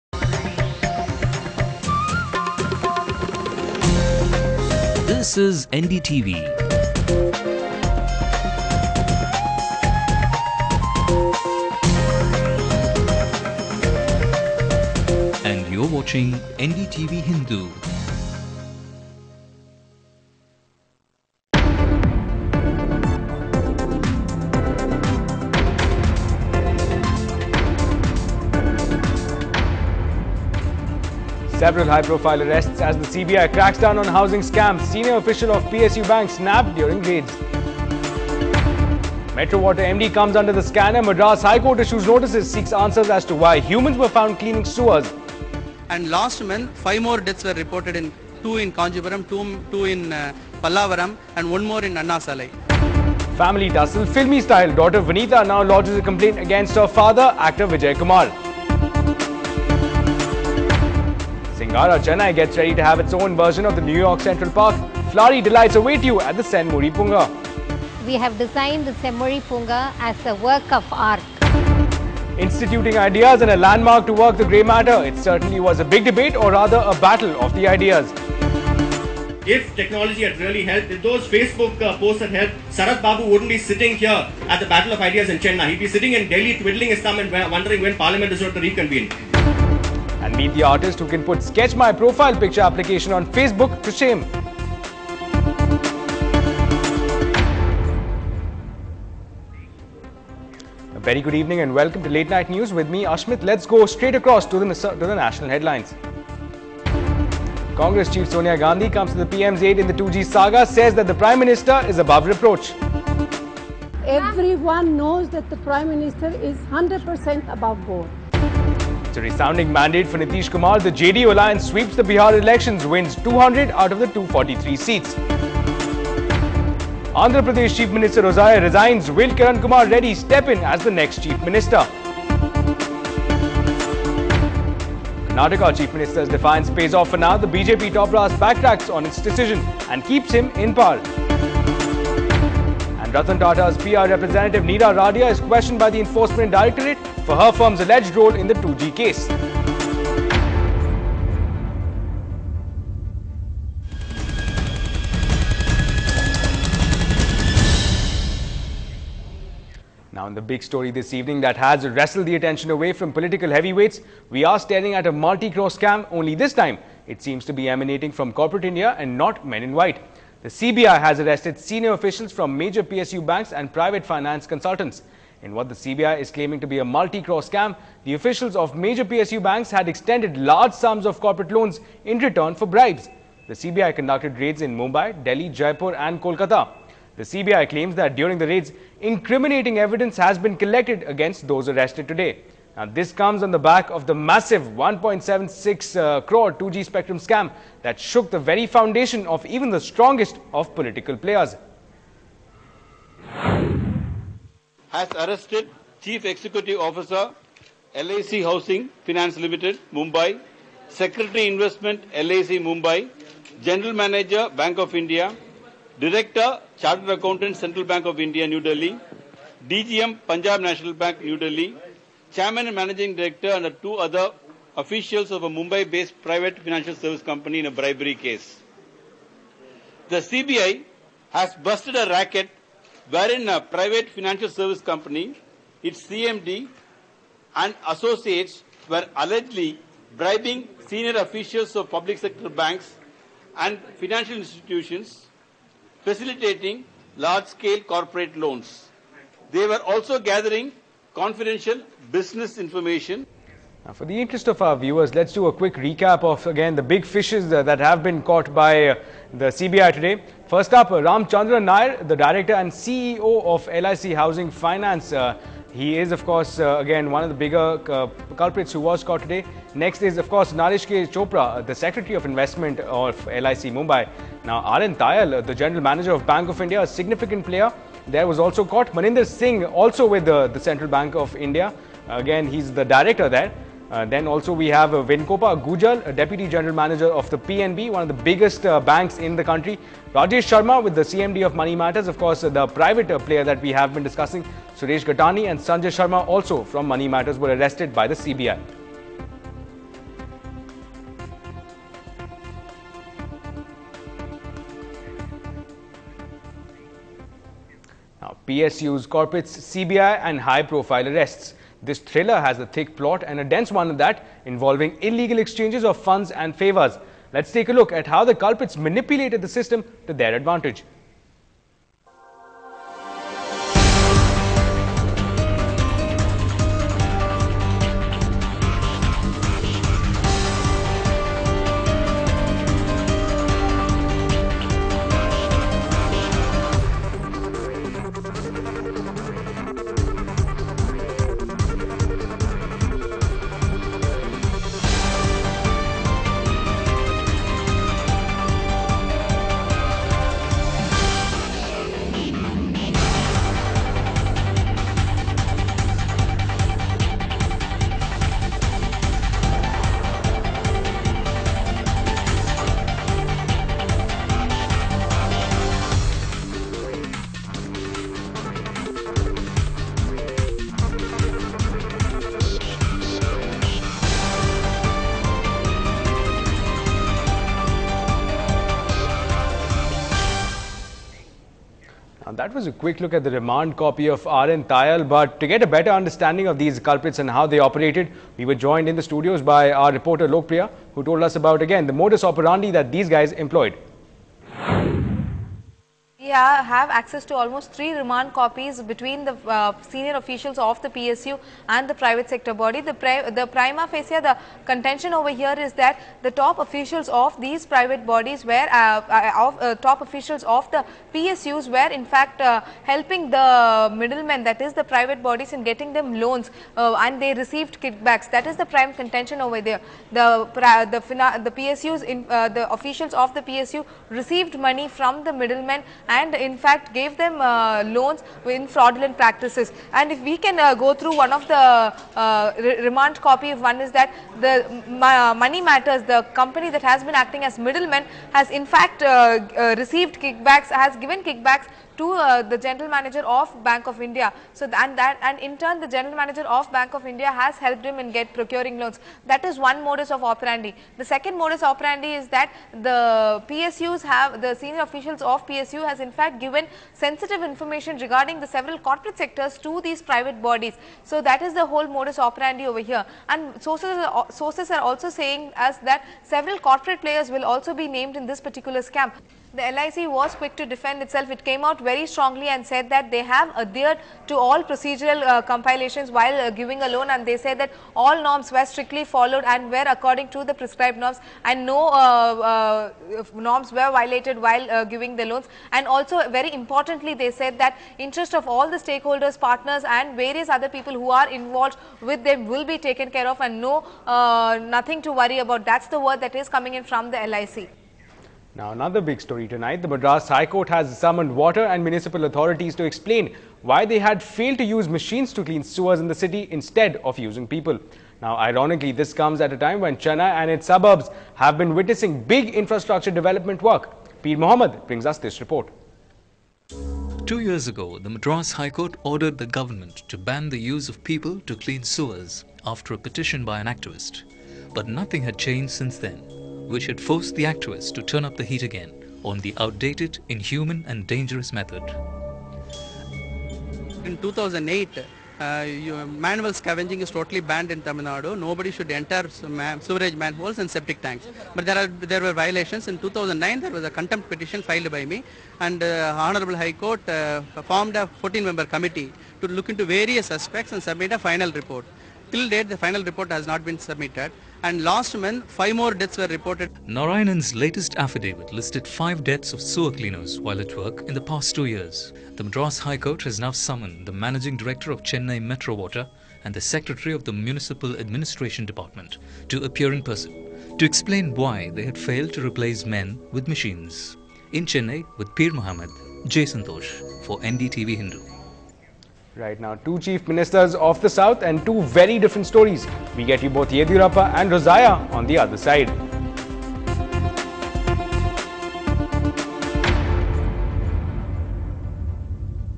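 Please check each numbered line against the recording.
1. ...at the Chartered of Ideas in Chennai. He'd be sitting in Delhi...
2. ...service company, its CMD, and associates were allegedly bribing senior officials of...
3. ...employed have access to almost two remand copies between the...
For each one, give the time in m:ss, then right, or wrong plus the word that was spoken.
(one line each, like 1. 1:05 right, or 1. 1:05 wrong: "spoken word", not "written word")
1. 1:24 wrong: "Battle", not "Chartered"
2. 3:54 right
3. 6:33 wrong: "three", not "two".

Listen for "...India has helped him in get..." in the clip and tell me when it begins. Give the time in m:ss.
7:27.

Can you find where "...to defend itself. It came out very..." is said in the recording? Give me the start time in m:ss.
7:50.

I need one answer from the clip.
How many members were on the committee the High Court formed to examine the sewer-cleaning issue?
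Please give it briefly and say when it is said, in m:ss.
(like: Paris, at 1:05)
14, at 9:08.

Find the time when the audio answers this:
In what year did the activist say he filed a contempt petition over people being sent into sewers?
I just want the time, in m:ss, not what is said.
9:03.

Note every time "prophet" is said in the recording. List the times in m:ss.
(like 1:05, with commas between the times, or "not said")
not said.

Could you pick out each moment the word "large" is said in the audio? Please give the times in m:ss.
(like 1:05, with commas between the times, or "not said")
3:00, 4:07.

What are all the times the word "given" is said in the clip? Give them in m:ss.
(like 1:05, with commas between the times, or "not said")
7:21, 7:36.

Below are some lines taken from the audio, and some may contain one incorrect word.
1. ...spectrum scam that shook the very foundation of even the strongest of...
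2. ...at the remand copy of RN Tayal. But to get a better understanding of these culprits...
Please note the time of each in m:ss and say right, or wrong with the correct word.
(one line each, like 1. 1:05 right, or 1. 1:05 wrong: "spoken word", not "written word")
1. 3:16 right
2. 6:23 right.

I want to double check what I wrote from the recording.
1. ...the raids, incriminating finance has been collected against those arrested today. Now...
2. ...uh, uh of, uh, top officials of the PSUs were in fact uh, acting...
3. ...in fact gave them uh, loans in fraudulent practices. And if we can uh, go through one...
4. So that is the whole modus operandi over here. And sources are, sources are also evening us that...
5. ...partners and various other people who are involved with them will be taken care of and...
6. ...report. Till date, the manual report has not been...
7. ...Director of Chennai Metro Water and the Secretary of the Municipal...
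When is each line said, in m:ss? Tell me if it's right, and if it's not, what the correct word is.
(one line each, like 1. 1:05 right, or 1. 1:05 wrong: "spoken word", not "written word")
1. 3:08 wrong: "evidence", not "finance"
2. 6:48 wrong: "helping", not "acting"
3. 7:06 right
4. 7:41 wrong: "saying", not "evening"
5. 8:09 right
6. 9:11 wrong: "final", not "manual"
7. 9:24 right.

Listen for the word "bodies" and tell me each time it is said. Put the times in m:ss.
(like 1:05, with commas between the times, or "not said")
6:48, 6:55, 7:40.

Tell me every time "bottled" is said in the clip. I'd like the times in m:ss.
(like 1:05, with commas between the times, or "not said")
not said.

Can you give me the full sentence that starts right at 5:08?
Now, PSU's corporates, CBI and high-profile arrests.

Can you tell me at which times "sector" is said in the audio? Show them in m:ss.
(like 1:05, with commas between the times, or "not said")
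4:02, 6:42, 7:39.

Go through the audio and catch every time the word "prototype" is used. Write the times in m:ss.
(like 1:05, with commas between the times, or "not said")
not said.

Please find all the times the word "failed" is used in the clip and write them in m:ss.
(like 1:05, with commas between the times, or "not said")
8:24, 9:31.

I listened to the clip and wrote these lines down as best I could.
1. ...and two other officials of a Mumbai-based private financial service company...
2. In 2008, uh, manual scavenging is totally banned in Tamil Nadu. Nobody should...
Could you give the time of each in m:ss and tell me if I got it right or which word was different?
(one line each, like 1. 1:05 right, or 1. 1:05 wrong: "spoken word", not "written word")
1. 3:43 right
2. 8:54 right.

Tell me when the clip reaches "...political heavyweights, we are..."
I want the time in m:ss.
2:43.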